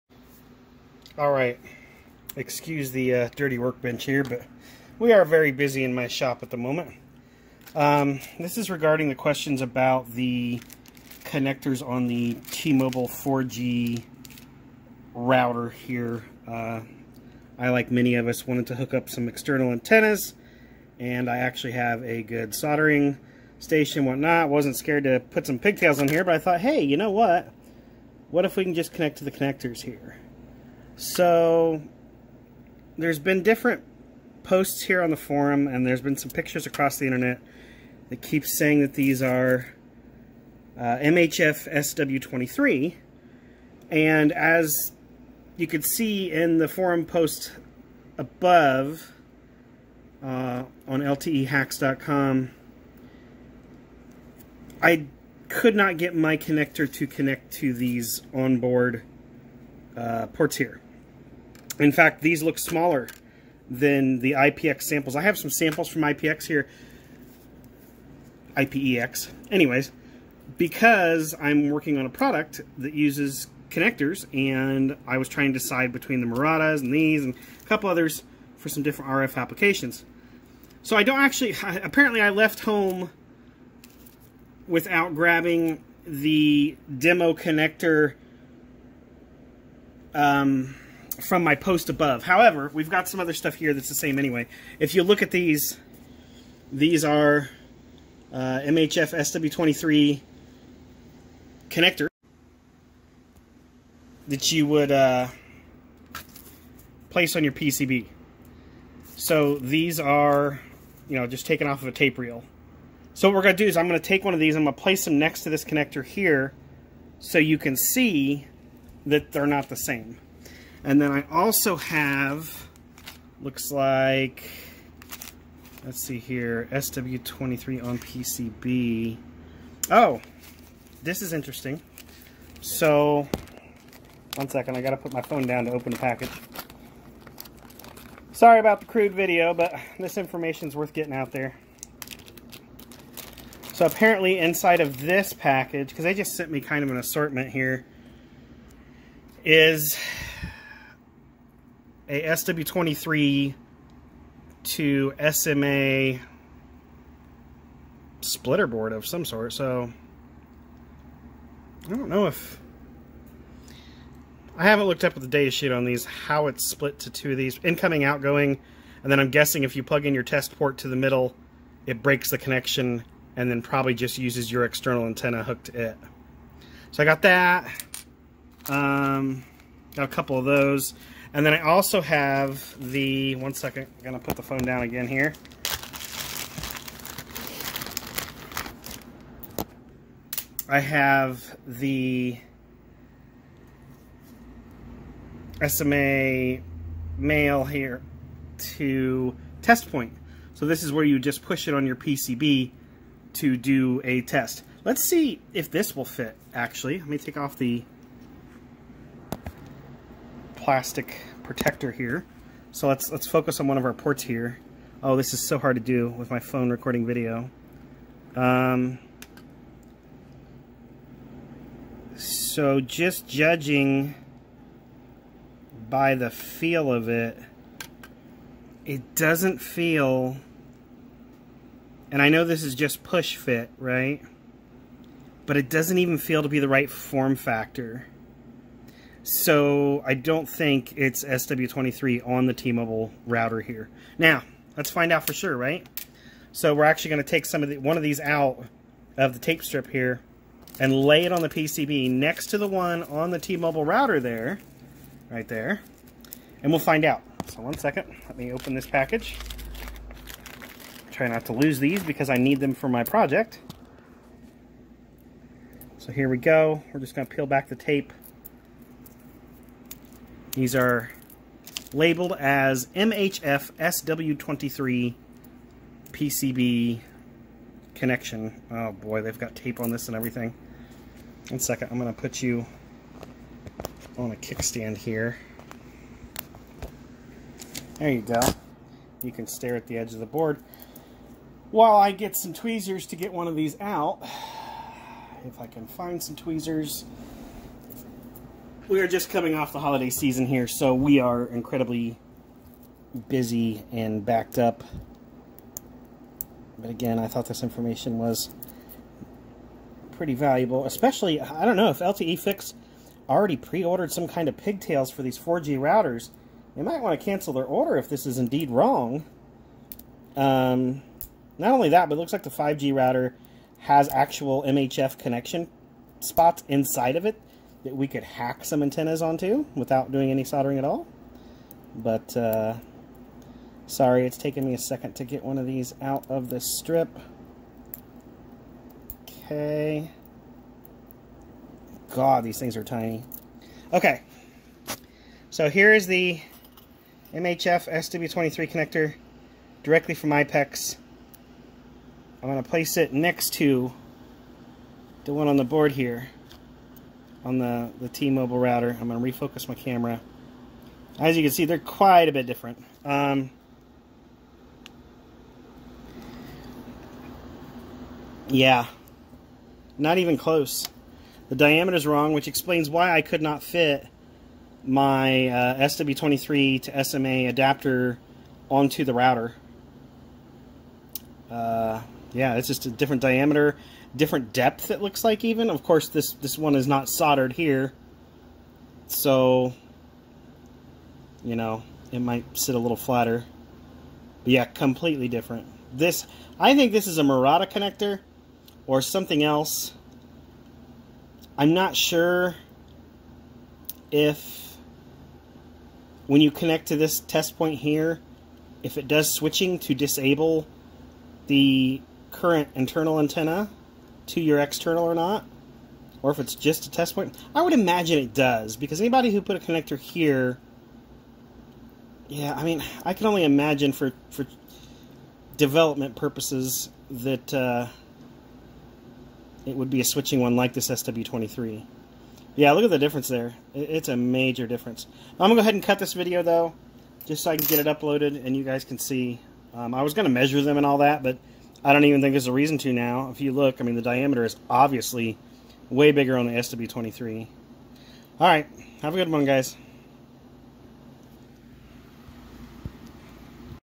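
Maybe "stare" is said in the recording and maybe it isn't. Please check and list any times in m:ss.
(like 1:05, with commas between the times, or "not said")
4:49.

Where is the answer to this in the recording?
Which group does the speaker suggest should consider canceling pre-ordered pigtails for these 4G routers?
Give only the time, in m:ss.
5:11.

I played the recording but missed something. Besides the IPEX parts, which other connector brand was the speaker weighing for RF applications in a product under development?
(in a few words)
Murata.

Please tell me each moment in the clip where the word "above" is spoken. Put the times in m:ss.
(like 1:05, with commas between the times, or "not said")
0:48, 1:31.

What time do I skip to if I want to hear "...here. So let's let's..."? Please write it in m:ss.
3:31.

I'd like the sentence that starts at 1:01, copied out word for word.
In fact, these look smaller than the IPX samples.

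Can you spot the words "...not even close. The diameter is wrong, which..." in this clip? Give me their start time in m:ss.
6:09.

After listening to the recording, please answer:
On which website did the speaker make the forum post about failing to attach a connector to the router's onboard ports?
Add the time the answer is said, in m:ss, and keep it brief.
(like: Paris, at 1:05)
LTEHacks.com, at 0:51.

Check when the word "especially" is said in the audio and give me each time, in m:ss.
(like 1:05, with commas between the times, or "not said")
5:10.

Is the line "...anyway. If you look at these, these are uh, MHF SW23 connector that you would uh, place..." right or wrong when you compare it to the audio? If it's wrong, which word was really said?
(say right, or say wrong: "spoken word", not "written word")
right.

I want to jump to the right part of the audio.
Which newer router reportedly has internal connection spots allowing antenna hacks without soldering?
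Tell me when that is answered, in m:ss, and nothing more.
5:22.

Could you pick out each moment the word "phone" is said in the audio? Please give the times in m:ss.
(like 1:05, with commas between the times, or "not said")
2:15, 3:04, 3:36.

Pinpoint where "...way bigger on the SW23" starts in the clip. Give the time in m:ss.
7:25.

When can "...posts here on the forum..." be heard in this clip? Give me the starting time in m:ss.
0:34.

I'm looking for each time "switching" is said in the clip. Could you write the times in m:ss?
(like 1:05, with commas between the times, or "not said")
6:49, 7:10.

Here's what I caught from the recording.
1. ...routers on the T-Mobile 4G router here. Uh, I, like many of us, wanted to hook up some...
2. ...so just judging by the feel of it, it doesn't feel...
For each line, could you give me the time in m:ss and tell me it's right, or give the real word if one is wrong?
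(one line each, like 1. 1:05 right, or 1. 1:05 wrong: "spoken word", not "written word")
1. 0:11 wrong: "connectors", not "routers"
2. 3:42 right.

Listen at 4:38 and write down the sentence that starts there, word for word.
Oh boy, they've got tape on this and everything.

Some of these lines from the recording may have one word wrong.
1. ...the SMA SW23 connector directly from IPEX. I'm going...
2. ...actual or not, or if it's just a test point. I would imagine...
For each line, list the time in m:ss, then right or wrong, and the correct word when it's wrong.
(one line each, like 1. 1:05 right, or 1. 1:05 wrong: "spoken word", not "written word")
1. 5:46 wrong: "MHF", not "SMA"
2. 6:54 wrong: "external", not "actual".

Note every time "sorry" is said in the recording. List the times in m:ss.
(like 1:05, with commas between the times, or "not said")
2:18, 5:33.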